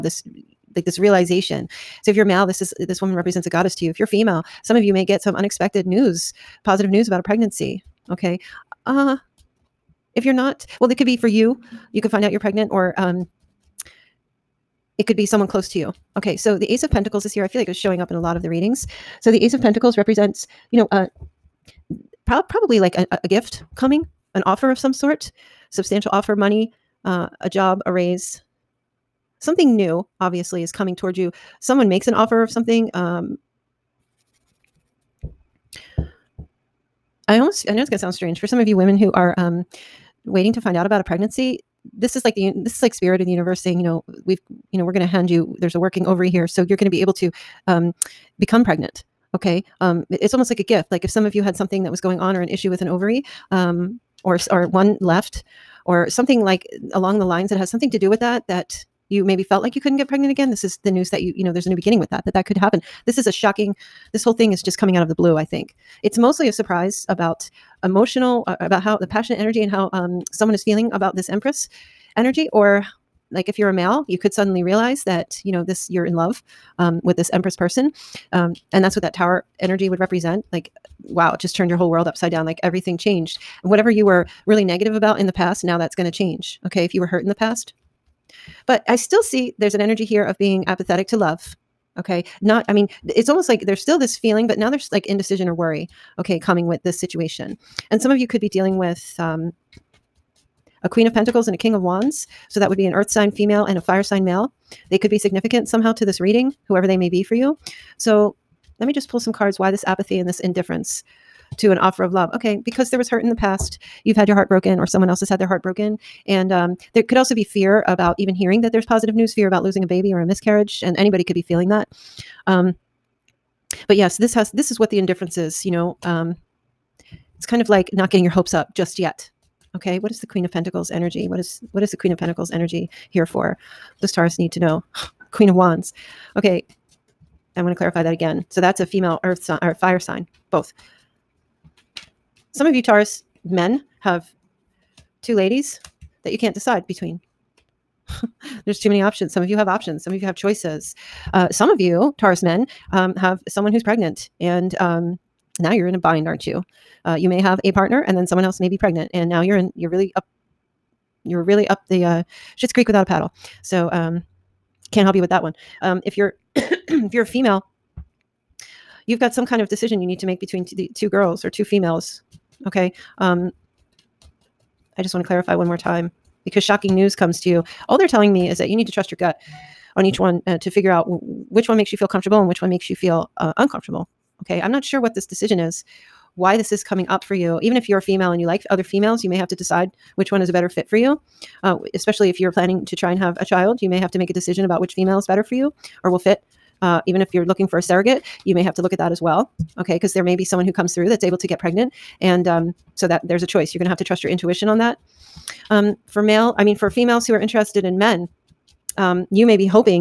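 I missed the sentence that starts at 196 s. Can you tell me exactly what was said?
Uh, even if you're looking for a surrogate, you may have to look at that as well.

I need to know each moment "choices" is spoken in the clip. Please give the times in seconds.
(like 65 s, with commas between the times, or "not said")
150 s, 203 s.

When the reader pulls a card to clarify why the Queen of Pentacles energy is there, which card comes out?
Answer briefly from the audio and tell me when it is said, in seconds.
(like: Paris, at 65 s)
Queen of Wands, at 135 s.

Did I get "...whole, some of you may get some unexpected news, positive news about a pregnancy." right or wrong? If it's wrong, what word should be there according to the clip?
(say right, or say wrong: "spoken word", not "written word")
wrong: "female", not "whole".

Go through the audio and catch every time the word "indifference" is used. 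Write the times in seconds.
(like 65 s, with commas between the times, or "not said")
110 s, 124 s.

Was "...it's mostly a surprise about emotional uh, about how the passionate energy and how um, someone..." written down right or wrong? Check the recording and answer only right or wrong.
right.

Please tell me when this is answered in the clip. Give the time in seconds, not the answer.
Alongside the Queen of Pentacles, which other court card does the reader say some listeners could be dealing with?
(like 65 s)
101 s.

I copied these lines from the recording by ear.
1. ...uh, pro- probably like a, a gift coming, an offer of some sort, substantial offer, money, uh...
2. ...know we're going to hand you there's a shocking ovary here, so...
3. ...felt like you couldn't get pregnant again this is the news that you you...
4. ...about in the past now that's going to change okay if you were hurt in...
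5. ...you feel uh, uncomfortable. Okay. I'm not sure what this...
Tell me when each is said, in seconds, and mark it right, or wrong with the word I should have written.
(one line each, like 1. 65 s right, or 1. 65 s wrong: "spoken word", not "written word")
1. 20 s right
2. 44 s wrong: "working", not "shocking"
3. 59 s right
4. 84 s right
5. 182 s right.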